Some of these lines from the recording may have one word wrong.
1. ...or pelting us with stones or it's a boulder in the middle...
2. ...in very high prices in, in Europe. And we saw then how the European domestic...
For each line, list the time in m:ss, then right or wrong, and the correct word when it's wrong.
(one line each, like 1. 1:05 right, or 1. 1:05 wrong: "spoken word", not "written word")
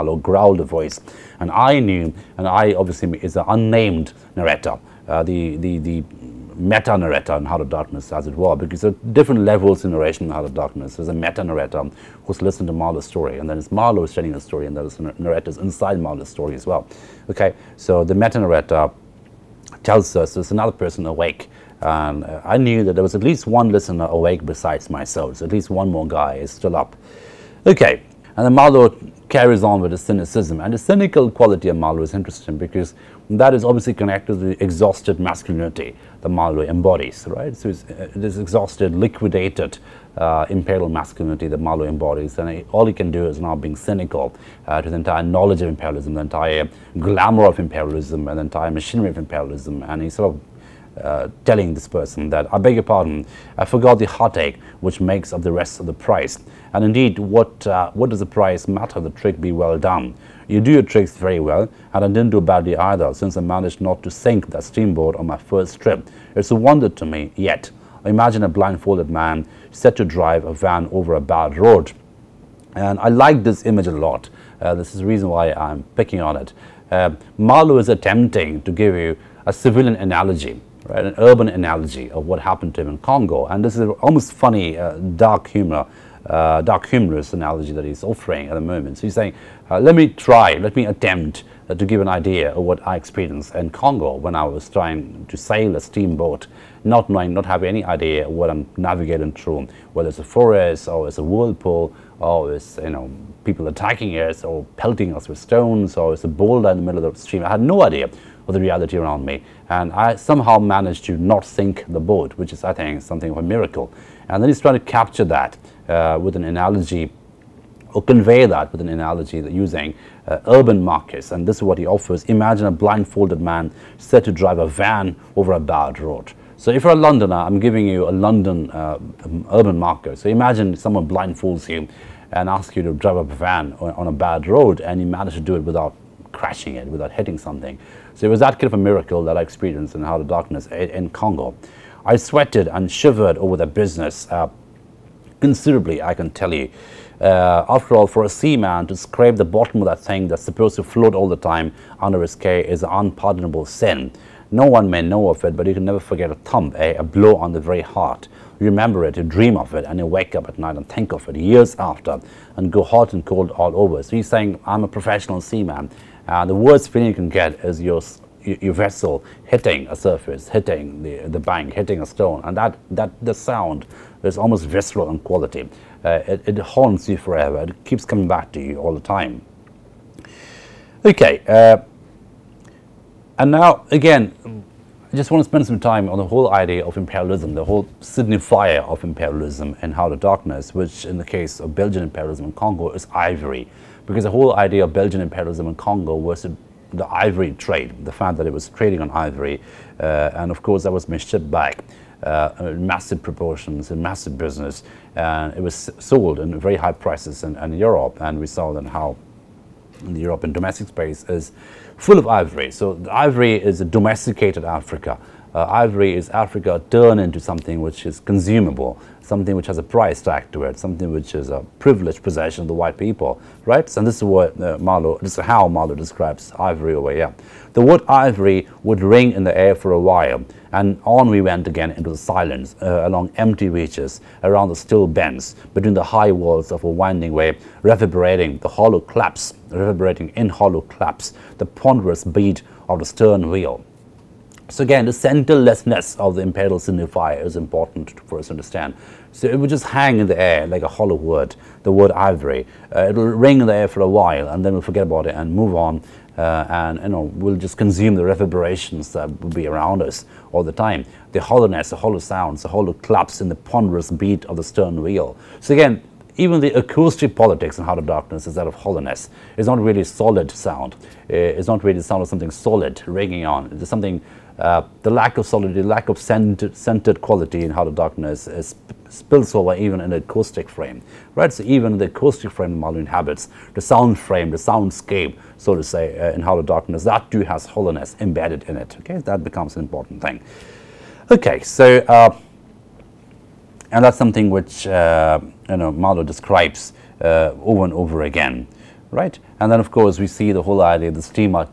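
1. 1:44 right
2. 3:26 right.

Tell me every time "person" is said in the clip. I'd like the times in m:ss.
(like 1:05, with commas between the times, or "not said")
0:20, 0:51.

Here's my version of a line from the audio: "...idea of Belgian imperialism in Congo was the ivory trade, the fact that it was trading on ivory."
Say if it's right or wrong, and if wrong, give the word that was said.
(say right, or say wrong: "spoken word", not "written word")
right.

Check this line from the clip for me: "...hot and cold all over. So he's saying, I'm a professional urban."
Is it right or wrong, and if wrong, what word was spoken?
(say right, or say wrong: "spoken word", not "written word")
wrong: "seaman", not "urban".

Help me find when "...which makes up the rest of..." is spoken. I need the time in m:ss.
0:54.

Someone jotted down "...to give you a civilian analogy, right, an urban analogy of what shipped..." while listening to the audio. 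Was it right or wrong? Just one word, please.
wrong.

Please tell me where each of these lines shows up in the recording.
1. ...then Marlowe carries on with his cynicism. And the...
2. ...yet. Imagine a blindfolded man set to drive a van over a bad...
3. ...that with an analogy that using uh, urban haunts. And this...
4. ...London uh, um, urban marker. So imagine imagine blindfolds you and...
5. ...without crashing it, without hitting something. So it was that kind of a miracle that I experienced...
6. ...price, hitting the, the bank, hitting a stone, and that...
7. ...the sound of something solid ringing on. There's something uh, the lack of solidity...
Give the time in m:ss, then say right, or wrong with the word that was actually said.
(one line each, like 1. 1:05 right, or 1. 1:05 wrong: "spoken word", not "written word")
1. 0:28 right
2. 1:07 right
3. 1:58 wrong: "markets", not "haunts"
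4. 2:08 wrong: "someone", not "imagine"
5. 2:15 right
6. 2:49 wrong: "surface", not "price"
7. 4:31 right.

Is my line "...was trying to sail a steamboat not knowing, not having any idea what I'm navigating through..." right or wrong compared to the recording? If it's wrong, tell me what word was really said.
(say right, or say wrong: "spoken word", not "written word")
right.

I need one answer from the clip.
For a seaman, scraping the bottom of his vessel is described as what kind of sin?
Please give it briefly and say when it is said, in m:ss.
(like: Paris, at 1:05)
An unpardonable sin, at 2:32.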